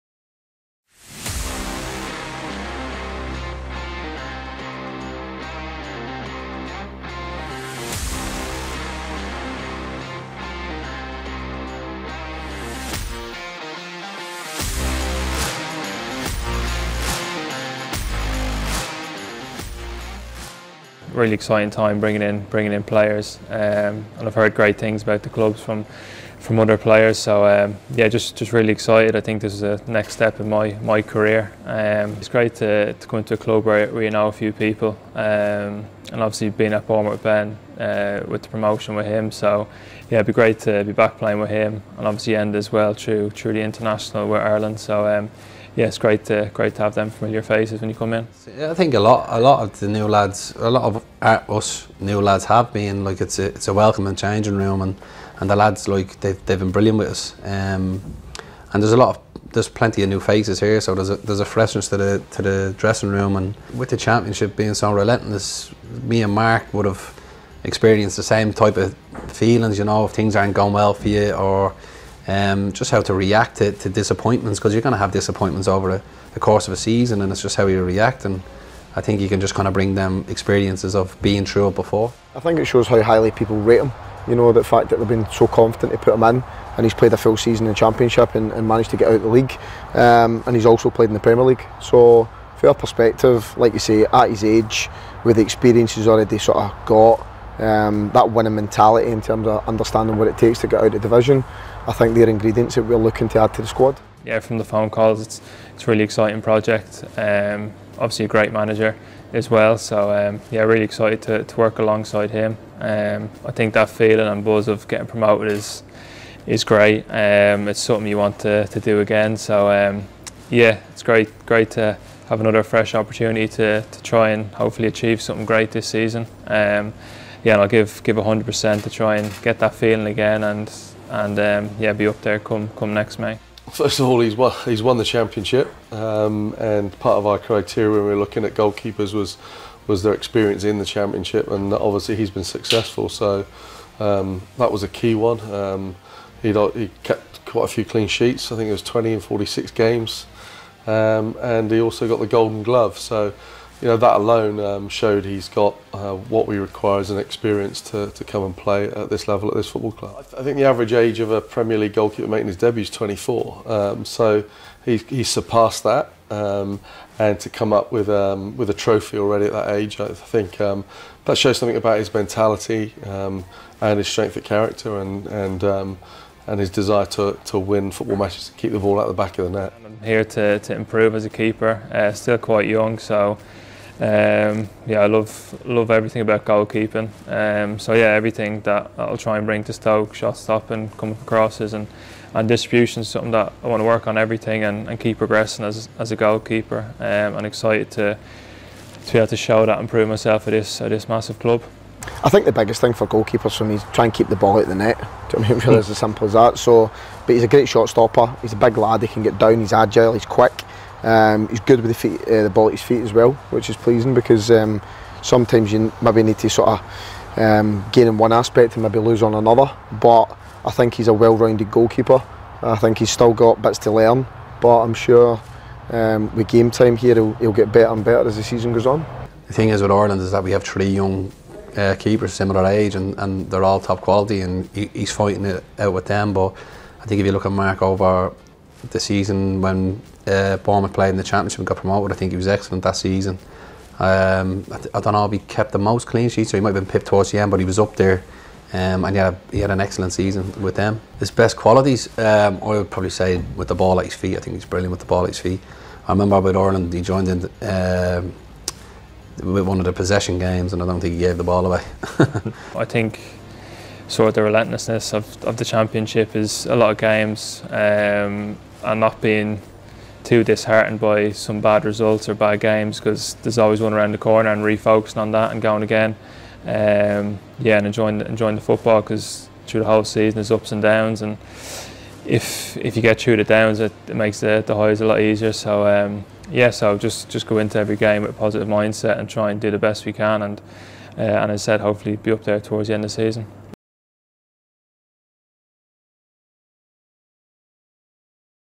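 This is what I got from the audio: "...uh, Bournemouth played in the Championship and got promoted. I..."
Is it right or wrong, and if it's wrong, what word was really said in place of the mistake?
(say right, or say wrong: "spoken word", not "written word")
right.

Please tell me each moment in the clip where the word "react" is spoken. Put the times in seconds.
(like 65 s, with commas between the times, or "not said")
73 s, 77 s.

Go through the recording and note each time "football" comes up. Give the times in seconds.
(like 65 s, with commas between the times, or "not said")
159 s, 177 s, 278 s.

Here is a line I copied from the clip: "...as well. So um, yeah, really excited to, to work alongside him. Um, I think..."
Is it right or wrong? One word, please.
right.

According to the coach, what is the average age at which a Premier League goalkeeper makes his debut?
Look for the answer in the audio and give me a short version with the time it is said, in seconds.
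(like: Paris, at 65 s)
24, at 162 s.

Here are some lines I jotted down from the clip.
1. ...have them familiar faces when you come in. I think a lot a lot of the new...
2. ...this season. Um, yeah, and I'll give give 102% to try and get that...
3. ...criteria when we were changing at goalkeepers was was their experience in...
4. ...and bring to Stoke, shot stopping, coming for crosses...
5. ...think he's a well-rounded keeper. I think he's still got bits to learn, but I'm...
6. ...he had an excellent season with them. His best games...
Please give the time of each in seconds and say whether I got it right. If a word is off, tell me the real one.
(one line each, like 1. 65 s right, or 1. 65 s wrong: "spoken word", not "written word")
1. 46 s right
2. 125 s wrong: "100", not "102"
3. 137 s wrong: "looking", not "changing"
4. 189 s right
5. 220 s wrong: "goalkeeper", not "keeper"
6. 249 s wrong: "qualities", not "games".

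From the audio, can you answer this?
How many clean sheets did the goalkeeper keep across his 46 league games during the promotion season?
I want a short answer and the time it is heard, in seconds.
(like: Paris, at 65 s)
20, at 148 s.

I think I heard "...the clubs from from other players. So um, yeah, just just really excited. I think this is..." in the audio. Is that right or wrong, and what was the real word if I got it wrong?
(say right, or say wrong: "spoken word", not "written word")
right.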